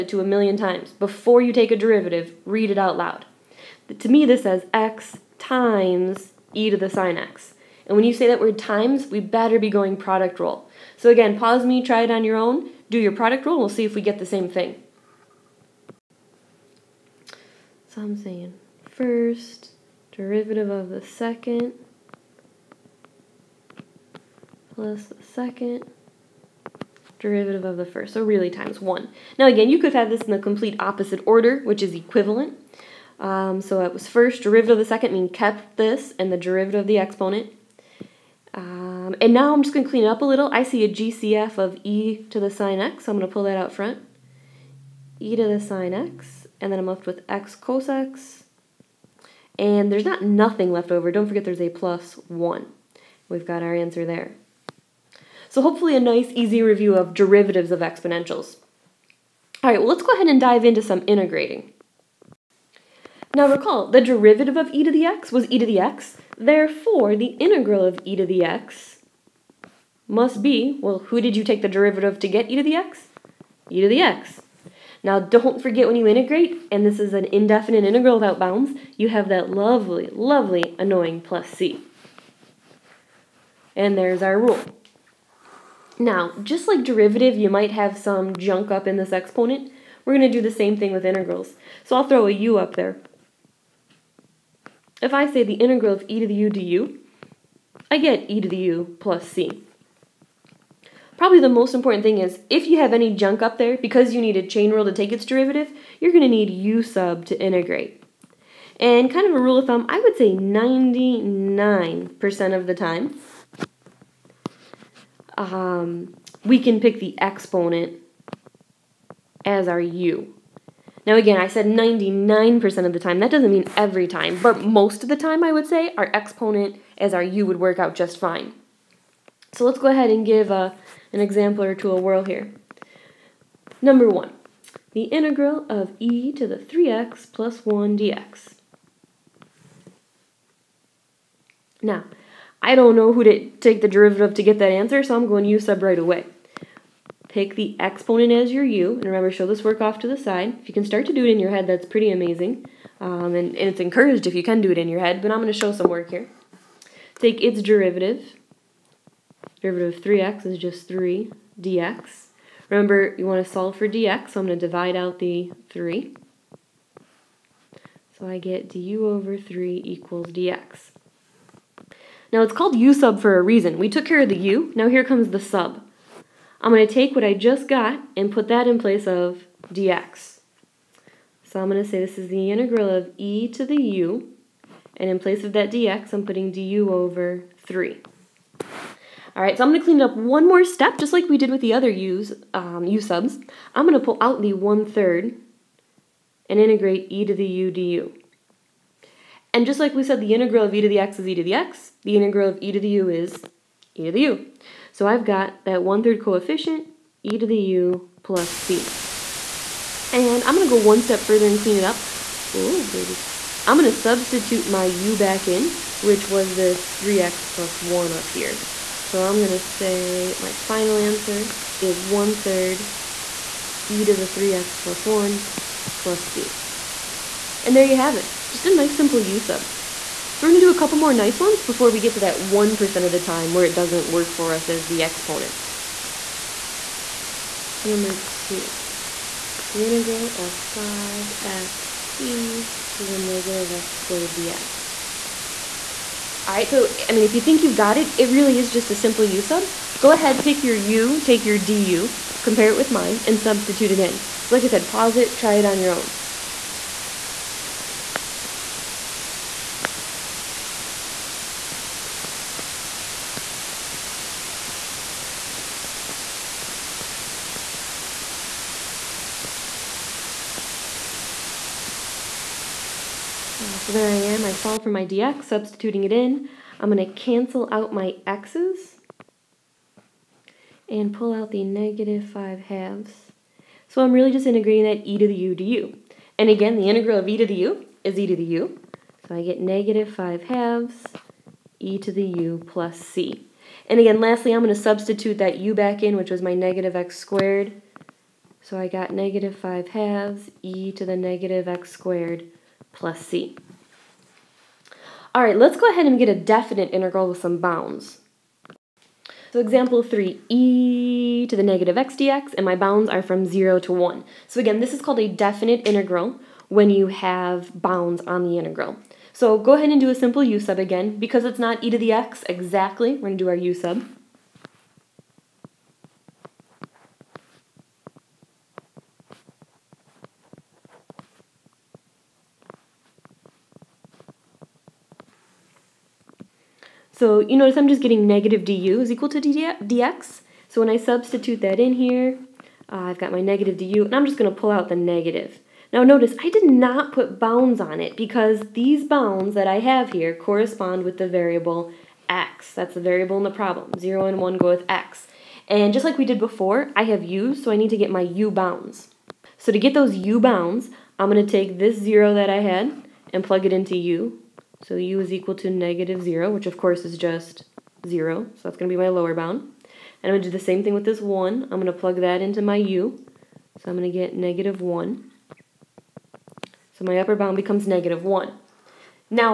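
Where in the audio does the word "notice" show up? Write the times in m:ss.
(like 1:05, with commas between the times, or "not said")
5:37, 5:46.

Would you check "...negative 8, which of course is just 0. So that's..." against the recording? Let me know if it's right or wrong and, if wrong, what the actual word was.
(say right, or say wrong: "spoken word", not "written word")
wrong: "0", not "8".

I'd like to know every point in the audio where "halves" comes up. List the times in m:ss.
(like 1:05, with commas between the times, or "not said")
4:42, 4:50, 4:59.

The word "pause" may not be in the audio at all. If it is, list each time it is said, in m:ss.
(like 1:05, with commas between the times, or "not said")
0:11, 4:14.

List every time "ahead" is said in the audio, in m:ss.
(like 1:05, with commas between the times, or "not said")
1:00, 2:09, 4:10, 5:05, 5:19.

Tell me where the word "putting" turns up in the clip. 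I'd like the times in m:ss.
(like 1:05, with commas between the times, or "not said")
3:06.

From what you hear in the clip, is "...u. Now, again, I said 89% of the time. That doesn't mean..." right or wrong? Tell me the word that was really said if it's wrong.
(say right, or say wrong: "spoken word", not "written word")
wrong: "99", not "89".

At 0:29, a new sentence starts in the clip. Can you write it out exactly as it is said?
Now again, you could have this in the complete opposite order, which is equivalent.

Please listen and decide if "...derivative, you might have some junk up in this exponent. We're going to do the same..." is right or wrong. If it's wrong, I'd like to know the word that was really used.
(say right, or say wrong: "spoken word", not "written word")
right.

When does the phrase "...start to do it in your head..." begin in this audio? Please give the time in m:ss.
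2:30.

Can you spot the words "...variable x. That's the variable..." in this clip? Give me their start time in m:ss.
5:51.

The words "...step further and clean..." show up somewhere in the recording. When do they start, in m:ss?
3:31.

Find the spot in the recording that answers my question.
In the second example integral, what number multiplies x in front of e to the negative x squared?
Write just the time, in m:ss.
4:00.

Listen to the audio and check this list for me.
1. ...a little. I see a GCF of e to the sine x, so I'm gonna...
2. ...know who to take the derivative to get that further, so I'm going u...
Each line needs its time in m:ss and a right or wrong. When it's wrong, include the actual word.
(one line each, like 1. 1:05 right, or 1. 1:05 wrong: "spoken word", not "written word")
1. 0:40 right
2. 2:22 wrong: "answer", not "further".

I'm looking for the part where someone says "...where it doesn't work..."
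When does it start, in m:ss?
3:53.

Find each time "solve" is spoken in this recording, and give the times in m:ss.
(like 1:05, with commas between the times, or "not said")
2:43, 4:34.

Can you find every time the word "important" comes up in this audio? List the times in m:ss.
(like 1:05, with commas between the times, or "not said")
1:41.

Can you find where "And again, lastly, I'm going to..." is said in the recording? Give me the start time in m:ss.
4:53.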